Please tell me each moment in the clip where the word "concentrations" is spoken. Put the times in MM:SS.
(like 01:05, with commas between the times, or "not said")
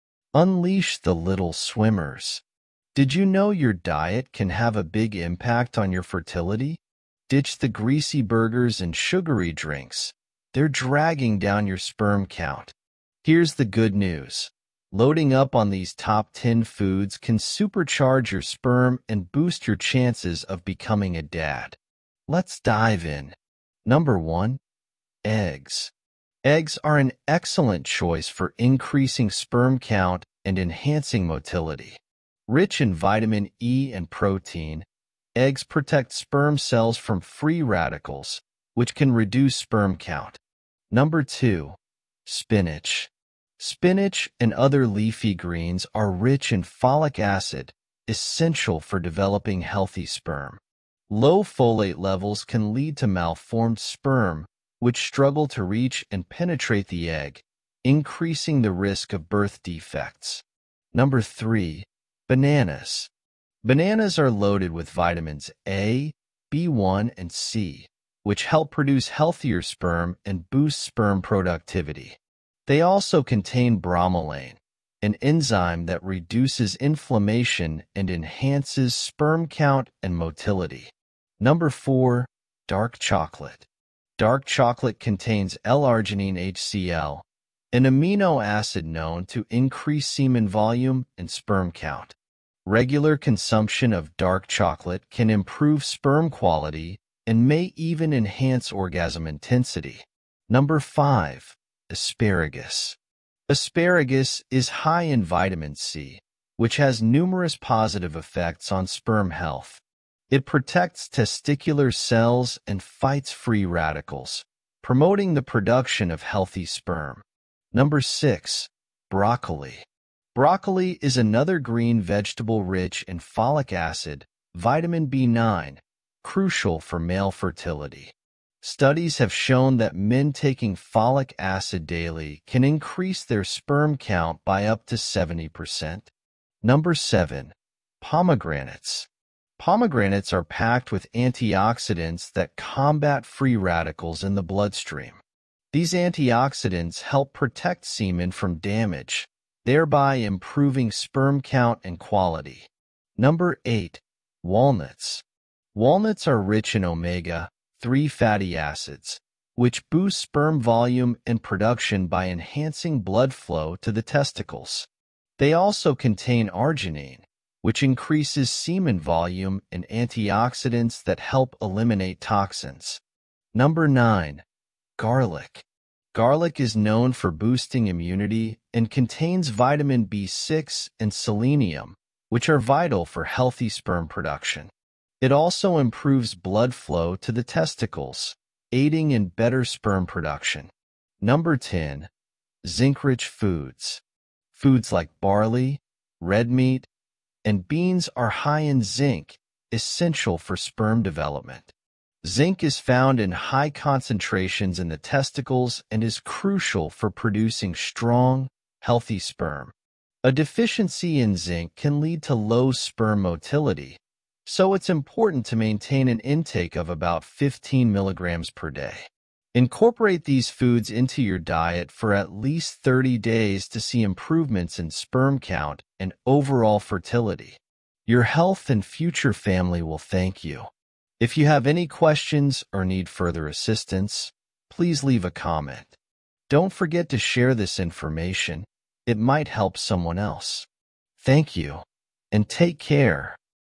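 03:23.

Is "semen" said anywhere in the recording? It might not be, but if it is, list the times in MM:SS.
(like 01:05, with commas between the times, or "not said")
01:30, 02:27, 02:48.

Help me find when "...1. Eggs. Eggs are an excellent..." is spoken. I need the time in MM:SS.
00:24.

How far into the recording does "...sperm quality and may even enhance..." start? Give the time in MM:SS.
01:35.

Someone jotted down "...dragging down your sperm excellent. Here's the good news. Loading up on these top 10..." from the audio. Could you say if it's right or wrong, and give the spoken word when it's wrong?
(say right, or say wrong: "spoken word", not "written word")
wrong: "count", not "excellent".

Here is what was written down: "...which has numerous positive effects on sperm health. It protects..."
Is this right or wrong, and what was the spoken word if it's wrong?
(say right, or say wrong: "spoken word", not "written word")
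right.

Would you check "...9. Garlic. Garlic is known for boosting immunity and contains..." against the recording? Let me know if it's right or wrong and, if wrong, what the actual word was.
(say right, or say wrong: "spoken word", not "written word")
right.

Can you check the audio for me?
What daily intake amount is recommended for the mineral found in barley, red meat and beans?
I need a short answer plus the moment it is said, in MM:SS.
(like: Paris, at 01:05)
15 milligrams, at 03:37.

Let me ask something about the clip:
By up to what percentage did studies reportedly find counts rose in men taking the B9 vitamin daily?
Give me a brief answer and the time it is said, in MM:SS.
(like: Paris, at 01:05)
70%, at 02:14.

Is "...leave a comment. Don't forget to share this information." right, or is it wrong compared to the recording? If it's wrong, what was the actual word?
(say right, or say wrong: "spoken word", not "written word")
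right.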